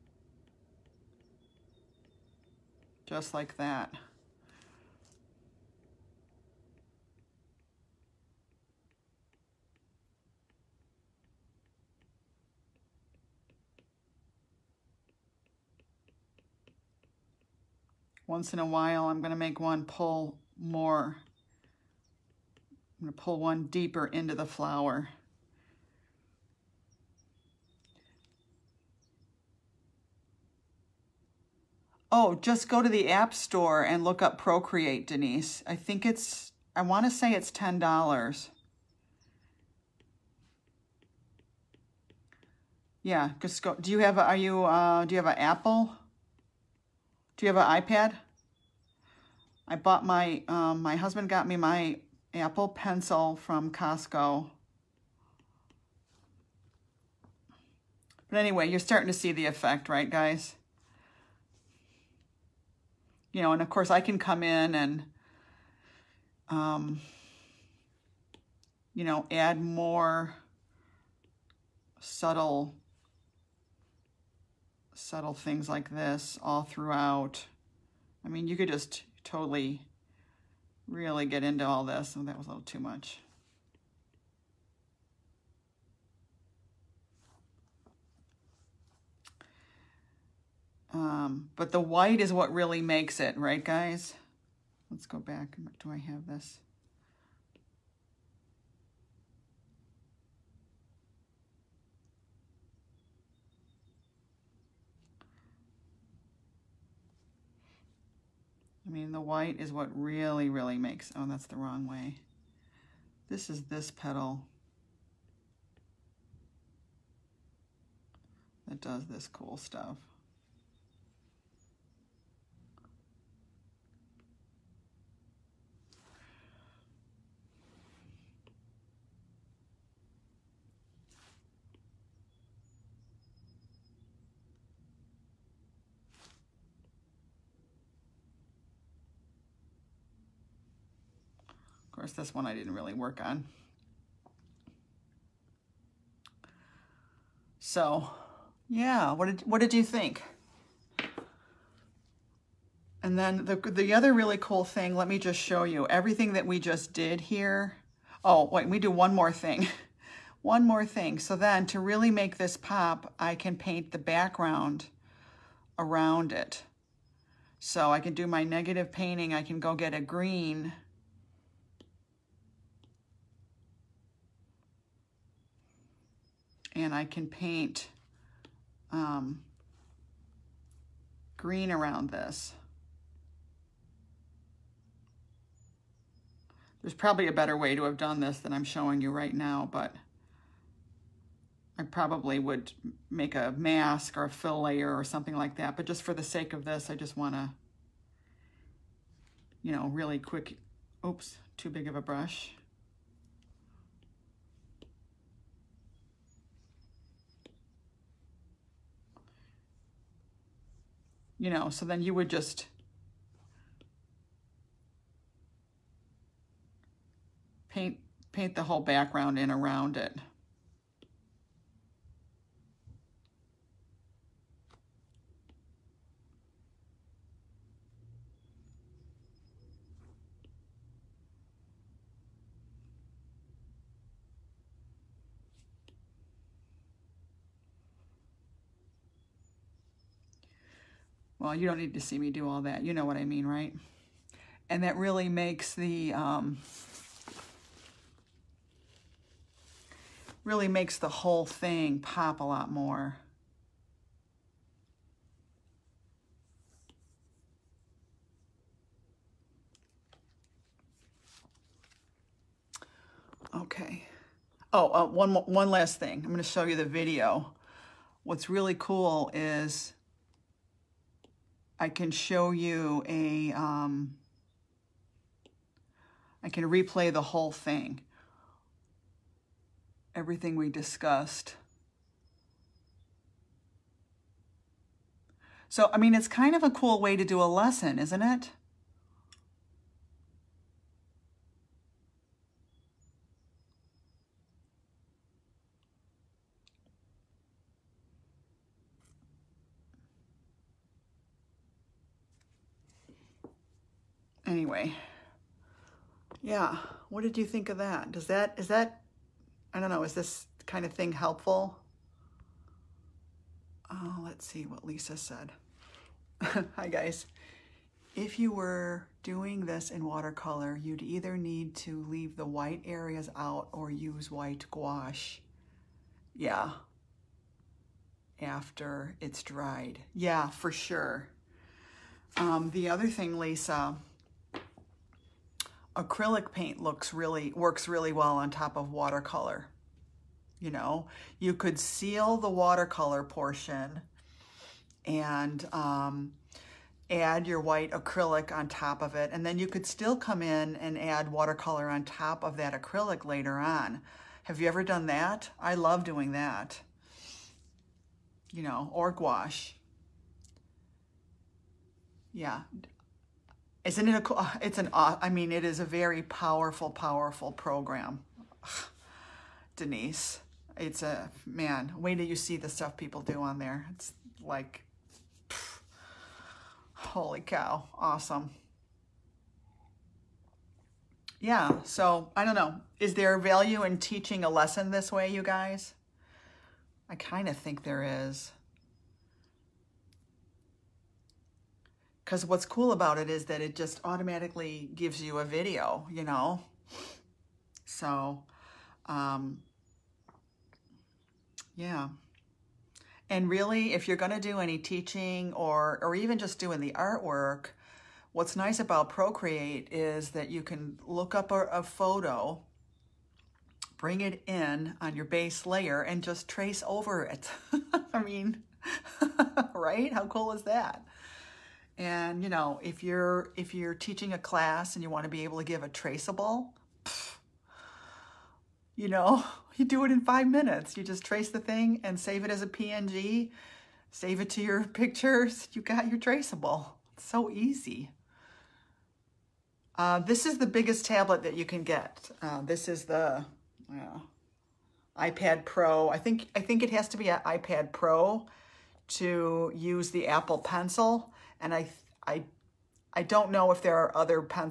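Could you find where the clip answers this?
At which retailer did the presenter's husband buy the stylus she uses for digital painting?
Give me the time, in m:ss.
0:53.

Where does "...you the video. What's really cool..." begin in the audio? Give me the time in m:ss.
4:26.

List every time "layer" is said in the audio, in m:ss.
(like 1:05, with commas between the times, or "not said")
3:14, 6:55.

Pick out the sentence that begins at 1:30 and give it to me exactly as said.
Um, but the white is what really makes it, right, guys?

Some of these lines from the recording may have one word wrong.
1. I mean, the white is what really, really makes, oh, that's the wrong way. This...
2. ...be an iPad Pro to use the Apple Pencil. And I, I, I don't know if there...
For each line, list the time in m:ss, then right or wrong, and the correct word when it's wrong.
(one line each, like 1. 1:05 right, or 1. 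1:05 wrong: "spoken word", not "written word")
1. 1:48 right
2. 7:27 right.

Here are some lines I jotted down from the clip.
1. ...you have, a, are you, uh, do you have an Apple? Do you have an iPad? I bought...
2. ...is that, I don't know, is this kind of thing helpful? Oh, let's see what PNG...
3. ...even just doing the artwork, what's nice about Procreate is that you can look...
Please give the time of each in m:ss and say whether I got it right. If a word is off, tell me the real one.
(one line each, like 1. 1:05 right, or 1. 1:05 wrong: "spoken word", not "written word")
1. 0:43 right
2. 5:08 wrong: "Lisa", not "PNG"
3. 6:46 right.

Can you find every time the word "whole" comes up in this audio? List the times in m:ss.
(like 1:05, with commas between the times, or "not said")
3:38, 4:11, 4:37.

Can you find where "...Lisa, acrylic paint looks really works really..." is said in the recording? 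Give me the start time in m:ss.
5:33.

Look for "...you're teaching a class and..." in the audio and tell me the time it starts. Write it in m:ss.
7:03.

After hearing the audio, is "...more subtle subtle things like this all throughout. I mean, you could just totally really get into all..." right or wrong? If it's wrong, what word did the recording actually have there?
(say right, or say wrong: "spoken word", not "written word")
right.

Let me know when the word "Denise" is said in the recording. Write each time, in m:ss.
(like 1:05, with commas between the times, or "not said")
0:35, 6:09.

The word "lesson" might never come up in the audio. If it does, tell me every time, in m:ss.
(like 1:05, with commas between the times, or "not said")
4:47, 6:24.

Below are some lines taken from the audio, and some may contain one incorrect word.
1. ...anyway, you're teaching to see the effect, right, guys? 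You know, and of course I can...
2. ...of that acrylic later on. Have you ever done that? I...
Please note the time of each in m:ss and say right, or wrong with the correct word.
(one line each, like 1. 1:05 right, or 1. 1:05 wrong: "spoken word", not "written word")
1. 0:58 wrong: "starting", not "teaching"
2. 5:52 right.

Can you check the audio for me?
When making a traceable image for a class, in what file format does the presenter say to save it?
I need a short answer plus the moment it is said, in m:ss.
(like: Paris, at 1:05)
PNG, at 7:12.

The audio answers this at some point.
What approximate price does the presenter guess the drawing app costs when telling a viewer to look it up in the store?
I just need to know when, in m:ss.
0:37.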